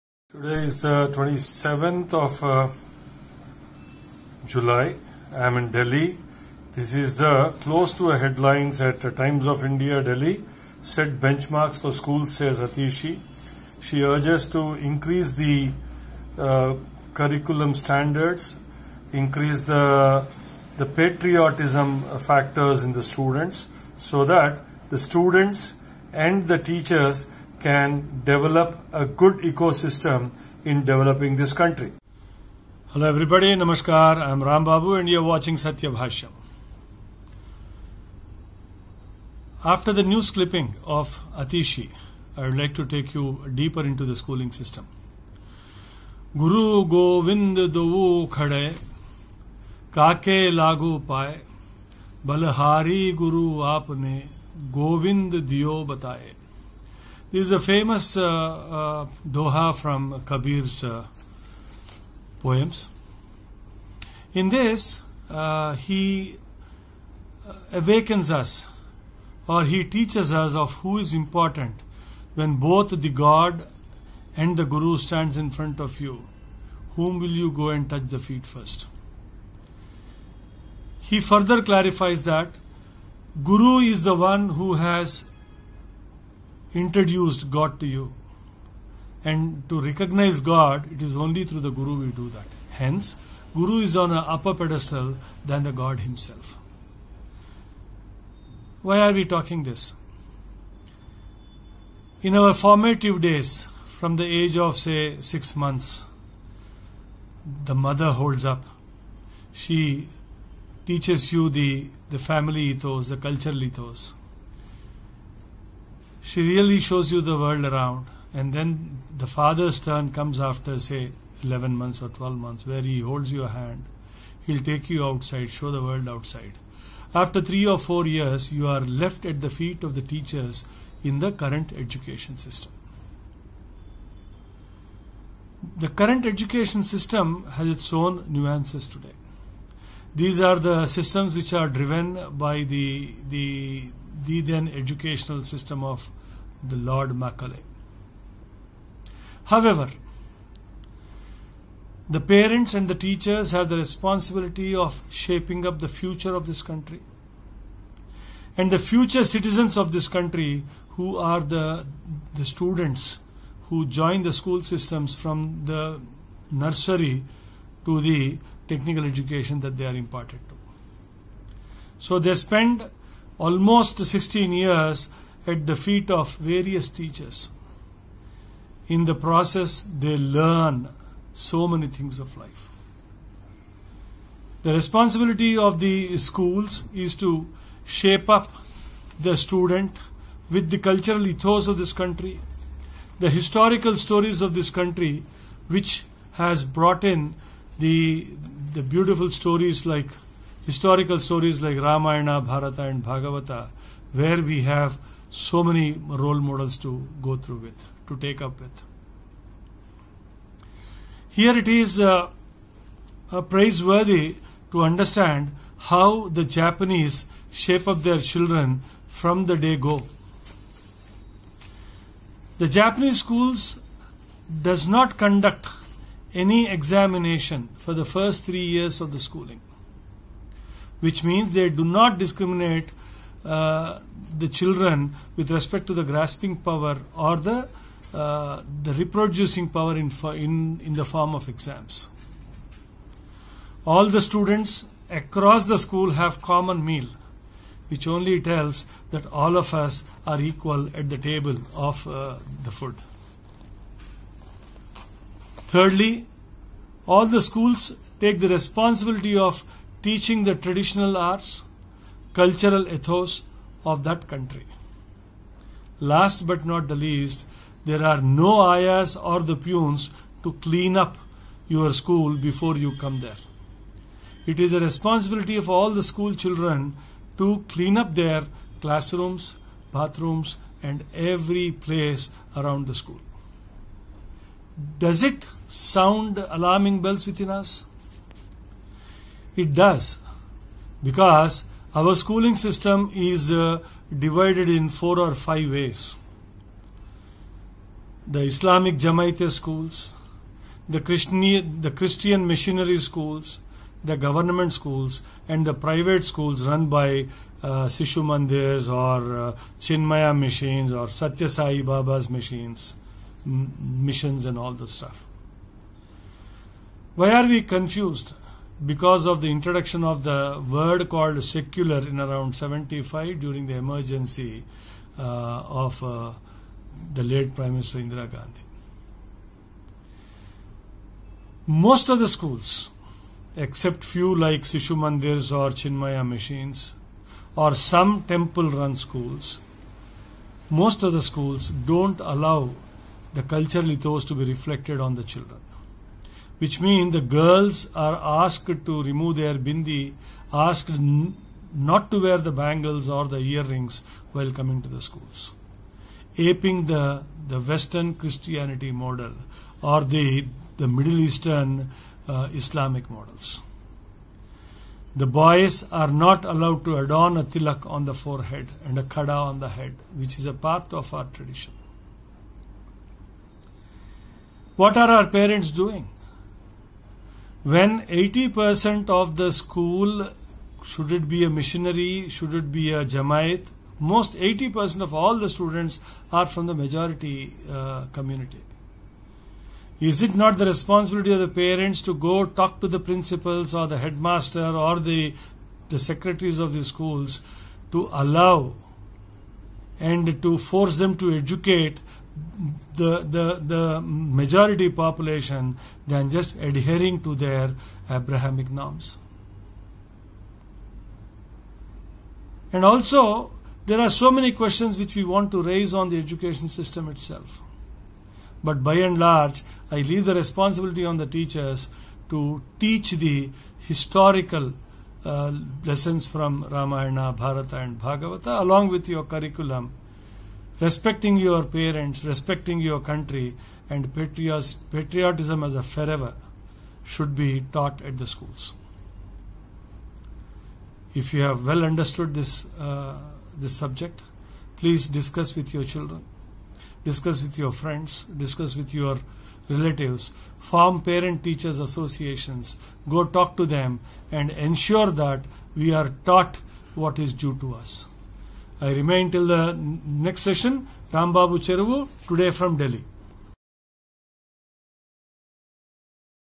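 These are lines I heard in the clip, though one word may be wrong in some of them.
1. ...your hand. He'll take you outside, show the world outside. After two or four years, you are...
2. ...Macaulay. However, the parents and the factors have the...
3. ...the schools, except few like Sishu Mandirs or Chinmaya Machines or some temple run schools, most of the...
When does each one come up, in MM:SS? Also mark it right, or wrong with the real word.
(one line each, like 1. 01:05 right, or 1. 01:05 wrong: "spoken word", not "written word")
1. 02:03 wrong: "three", not "two"
2. 02:27 wrong: "teachers", not "factors"
3. 05:32 right.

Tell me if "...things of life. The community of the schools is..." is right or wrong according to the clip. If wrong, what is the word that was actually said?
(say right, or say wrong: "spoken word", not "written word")
wrong: "responsibility", not "community".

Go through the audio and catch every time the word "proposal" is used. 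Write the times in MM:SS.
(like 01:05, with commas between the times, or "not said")
not said.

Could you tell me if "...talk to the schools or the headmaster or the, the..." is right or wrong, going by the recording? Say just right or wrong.
wrong.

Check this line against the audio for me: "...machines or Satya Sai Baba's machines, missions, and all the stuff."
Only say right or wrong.
right.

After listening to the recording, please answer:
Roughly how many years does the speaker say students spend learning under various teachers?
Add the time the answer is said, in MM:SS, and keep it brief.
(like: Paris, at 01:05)
16, at 02:54.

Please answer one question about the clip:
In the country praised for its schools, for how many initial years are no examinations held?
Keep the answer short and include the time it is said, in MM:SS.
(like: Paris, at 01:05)
3, at 03:48.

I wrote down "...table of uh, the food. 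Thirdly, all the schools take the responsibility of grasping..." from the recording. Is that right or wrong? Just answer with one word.
wrong.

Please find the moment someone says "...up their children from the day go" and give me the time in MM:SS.
03:37.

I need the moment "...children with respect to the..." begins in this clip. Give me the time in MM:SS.
03:54.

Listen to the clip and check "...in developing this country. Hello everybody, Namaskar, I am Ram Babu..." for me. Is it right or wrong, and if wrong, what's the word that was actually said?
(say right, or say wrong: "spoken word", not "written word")
right.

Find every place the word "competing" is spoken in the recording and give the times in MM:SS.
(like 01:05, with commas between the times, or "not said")
not said.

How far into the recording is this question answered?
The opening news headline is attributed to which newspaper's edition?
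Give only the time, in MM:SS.
00:09.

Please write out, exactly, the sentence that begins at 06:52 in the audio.
And also, there are so many questions which we want to raise on the education system itself.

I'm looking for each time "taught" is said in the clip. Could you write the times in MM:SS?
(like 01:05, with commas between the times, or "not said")
07:17, 07:36.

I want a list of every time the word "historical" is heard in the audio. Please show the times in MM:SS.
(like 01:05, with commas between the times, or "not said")
03:13, 03:20, 07:03.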